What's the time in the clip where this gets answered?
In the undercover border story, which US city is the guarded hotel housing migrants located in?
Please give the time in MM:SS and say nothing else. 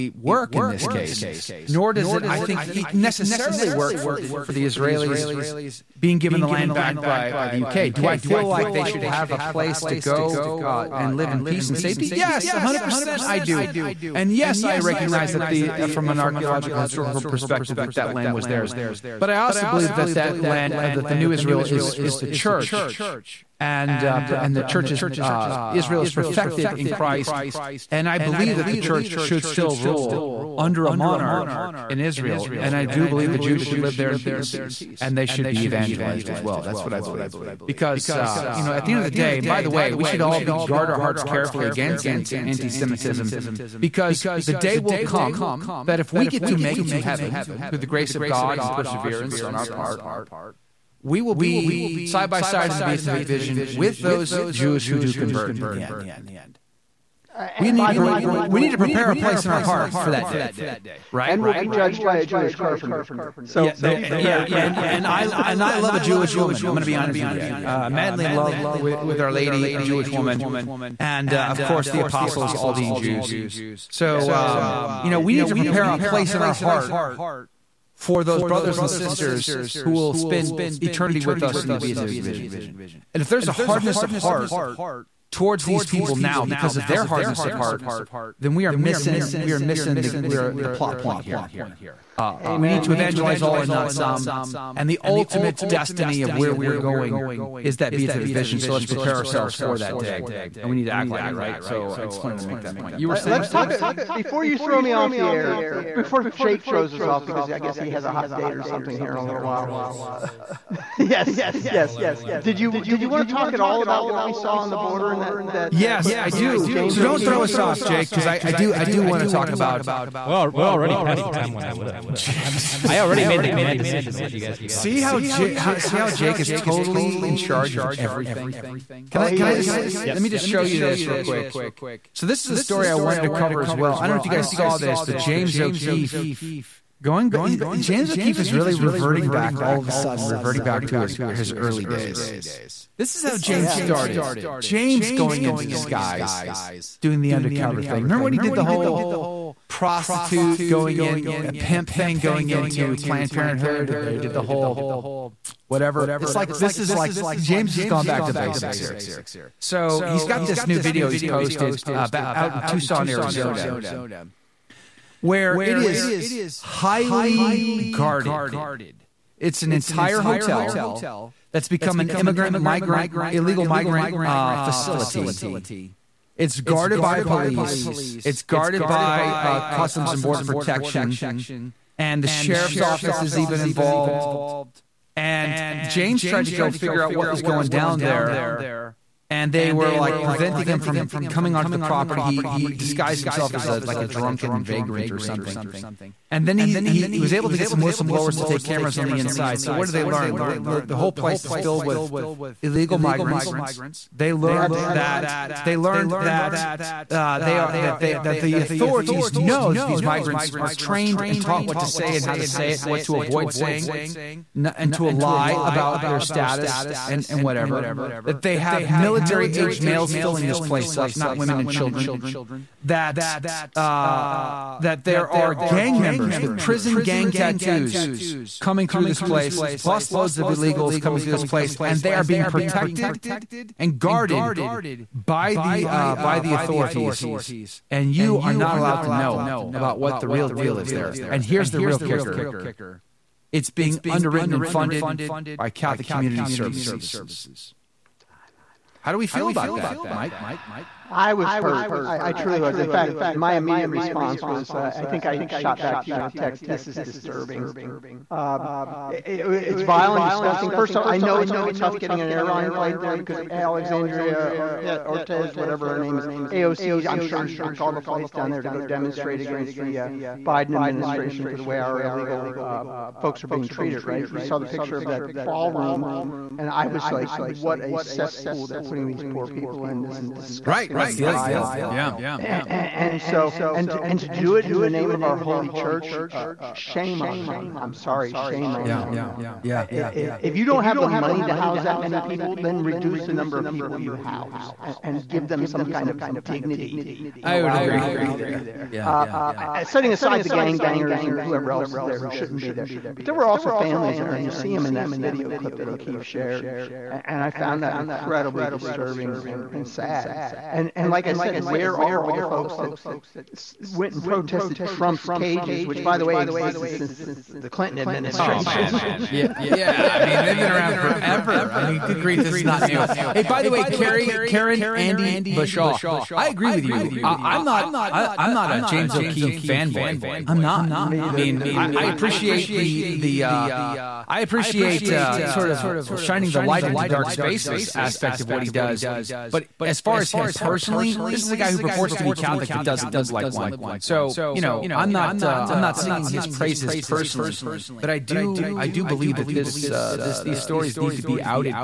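02:42.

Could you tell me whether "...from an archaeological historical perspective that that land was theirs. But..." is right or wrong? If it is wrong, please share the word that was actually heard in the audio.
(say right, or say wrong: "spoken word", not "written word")
right.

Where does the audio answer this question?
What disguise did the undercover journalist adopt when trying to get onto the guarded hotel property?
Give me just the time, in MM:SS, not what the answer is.
03:14.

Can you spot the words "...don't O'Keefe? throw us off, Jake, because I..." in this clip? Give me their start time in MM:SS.
01:57.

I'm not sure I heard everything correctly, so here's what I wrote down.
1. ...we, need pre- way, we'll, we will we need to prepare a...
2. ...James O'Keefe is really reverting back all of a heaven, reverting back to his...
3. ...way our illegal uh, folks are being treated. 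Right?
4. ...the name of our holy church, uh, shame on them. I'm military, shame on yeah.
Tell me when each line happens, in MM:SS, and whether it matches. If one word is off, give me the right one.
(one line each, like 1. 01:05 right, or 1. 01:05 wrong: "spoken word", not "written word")
1. 00:57 right
2. 02:17 wrong: "sudden", not "heaven"
3. 04:31 right
4. 04:44 wrong: "sorry", not "military".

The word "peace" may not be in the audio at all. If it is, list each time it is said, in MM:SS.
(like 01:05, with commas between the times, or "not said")
00:11, 00:34.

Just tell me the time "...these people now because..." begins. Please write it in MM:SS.
01:25.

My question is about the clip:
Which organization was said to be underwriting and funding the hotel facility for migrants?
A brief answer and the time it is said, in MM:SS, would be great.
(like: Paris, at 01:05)
Catholic Community Services, at 04:05.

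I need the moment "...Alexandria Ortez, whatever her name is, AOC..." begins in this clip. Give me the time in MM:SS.
04:23.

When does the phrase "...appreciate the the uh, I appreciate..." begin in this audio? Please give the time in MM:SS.
05:32.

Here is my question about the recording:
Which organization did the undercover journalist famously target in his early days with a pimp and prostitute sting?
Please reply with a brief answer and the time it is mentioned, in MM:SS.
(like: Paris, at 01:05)
Planned Parenthood, at 02:32.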